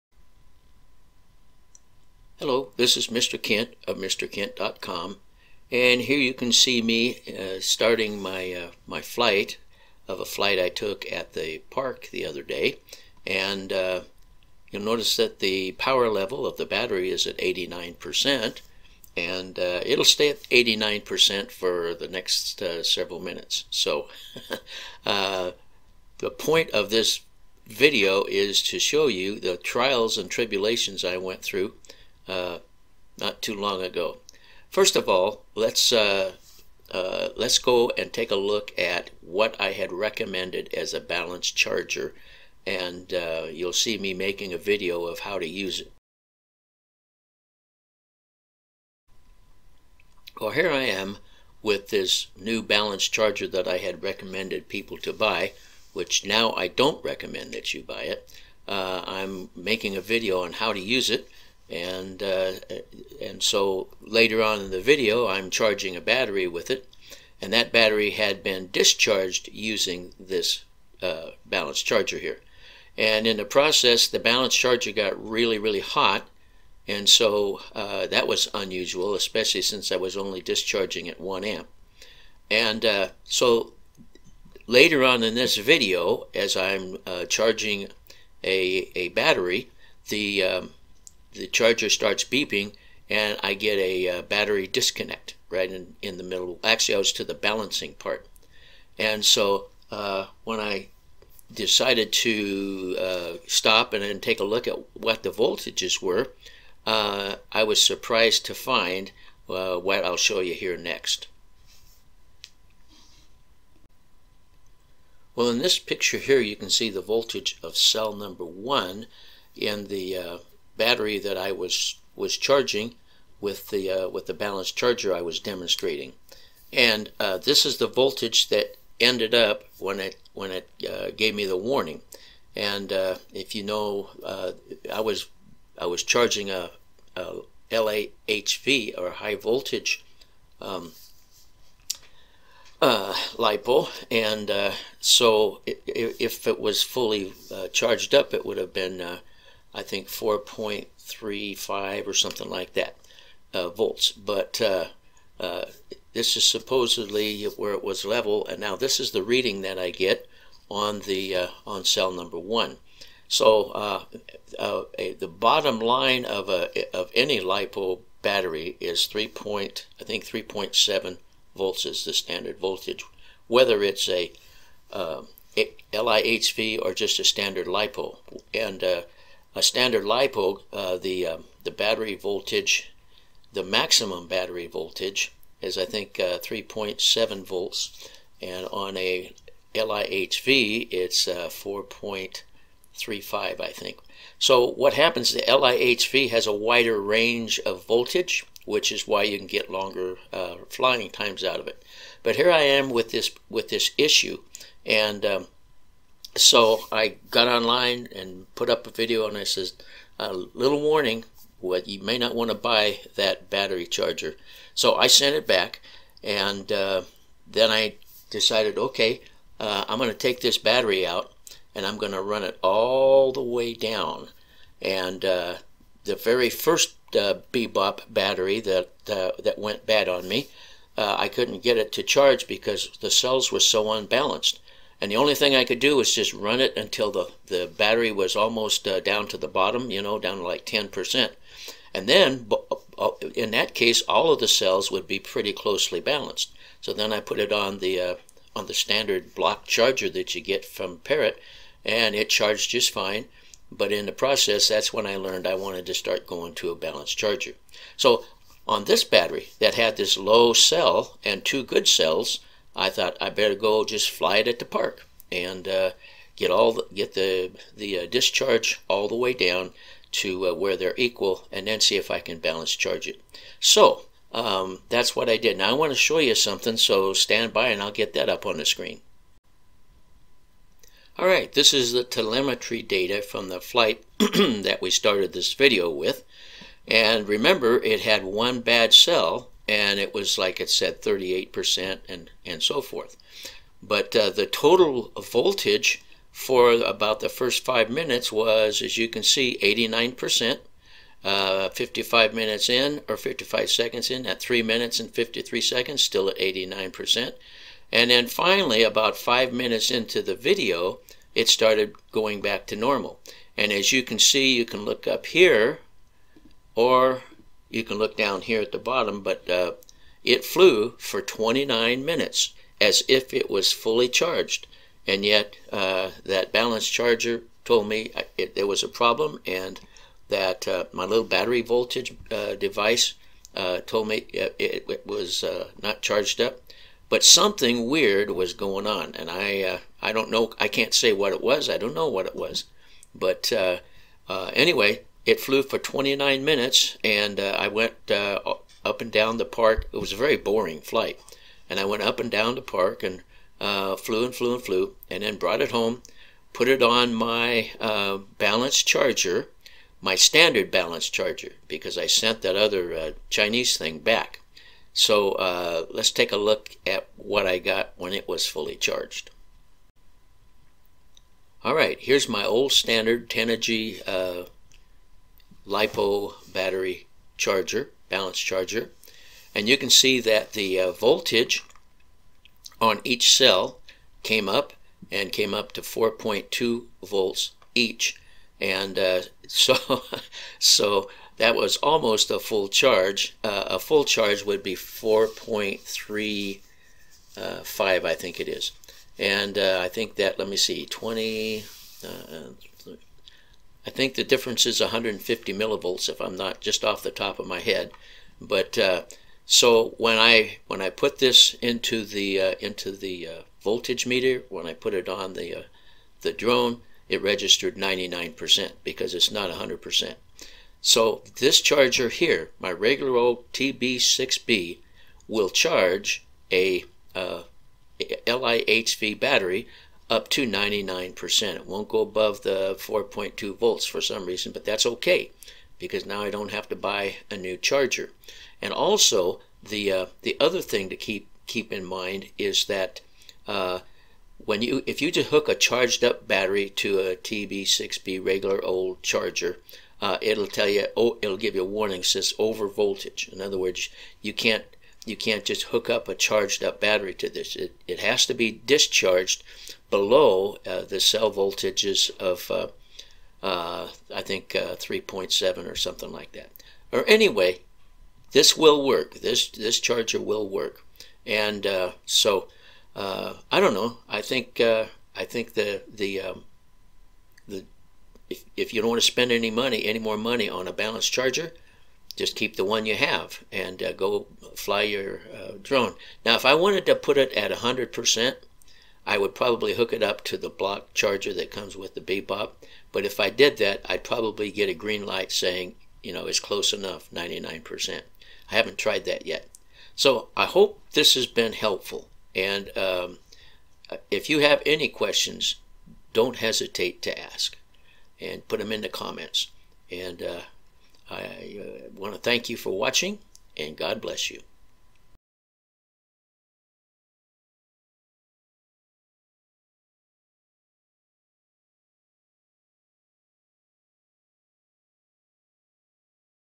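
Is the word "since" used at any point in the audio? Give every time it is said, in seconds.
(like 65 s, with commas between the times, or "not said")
79 s.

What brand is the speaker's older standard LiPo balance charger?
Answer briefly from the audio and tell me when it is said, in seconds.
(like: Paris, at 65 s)
Tenergy, at 373 s.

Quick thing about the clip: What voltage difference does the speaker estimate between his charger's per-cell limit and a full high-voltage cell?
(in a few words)
150 millivolts.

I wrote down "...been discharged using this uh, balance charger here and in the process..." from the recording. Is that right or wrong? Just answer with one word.
right.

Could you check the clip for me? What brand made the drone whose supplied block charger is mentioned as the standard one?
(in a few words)
Parrot.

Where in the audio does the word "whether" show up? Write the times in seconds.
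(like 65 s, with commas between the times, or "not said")
173 s.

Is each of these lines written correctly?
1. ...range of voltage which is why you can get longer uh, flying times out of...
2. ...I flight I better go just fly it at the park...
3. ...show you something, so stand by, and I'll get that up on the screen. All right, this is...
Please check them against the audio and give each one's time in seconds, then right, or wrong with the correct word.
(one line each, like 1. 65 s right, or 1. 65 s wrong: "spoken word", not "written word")
1. 197 s right
2. 262 s wrong: "thought", not "flight"
3. 275 s right.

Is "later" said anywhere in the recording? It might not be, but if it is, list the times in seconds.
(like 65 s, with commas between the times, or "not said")
64 s, 84 s.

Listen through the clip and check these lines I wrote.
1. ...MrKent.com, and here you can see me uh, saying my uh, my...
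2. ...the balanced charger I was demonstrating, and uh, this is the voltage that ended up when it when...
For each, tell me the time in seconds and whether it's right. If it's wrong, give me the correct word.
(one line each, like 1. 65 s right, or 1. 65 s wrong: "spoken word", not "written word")
1. 3 s wrong: "starting", not "saying"
2. 124 s right.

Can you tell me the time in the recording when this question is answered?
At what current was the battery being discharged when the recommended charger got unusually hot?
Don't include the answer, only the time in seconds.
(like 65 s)
81 s.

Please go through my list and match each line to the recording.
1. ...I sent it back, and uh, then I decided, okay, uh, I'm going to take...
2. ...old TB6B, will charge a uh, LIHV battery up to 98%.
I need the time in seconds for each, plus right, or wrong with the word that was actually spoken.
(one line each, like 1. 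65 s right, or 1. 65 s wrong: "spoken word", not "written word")
1. 214 s right
2. 423 s wrong: "99", not "98".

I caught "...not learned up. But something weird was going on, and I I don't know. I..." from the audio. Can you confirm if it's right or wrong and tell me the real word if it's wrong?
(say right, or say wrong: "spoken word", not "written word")
wrong: "charged", not "learned".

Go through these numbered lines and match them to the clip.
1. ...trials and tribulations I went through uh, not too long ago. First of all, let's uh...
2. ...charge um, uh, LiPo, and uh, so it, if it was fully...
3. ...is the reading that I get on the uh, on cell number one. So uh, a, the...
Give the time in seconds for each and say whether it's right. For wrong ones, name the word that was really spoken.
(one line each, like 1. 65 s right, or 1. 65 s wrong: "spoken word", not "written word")
1. 29 s right
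2. 139 s wrong: "voltage", not "charge"
3. 158 s right.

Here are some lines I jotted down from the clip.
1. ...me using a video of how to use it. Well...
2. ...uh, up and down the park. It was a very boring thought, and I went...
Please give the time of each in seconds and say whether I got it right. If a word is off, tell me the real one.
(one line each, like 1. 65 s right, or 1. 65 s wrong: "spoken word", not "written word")
1. 43 s wrong: "making", not "using"
2. 348 s wrong: "flight", not "thought".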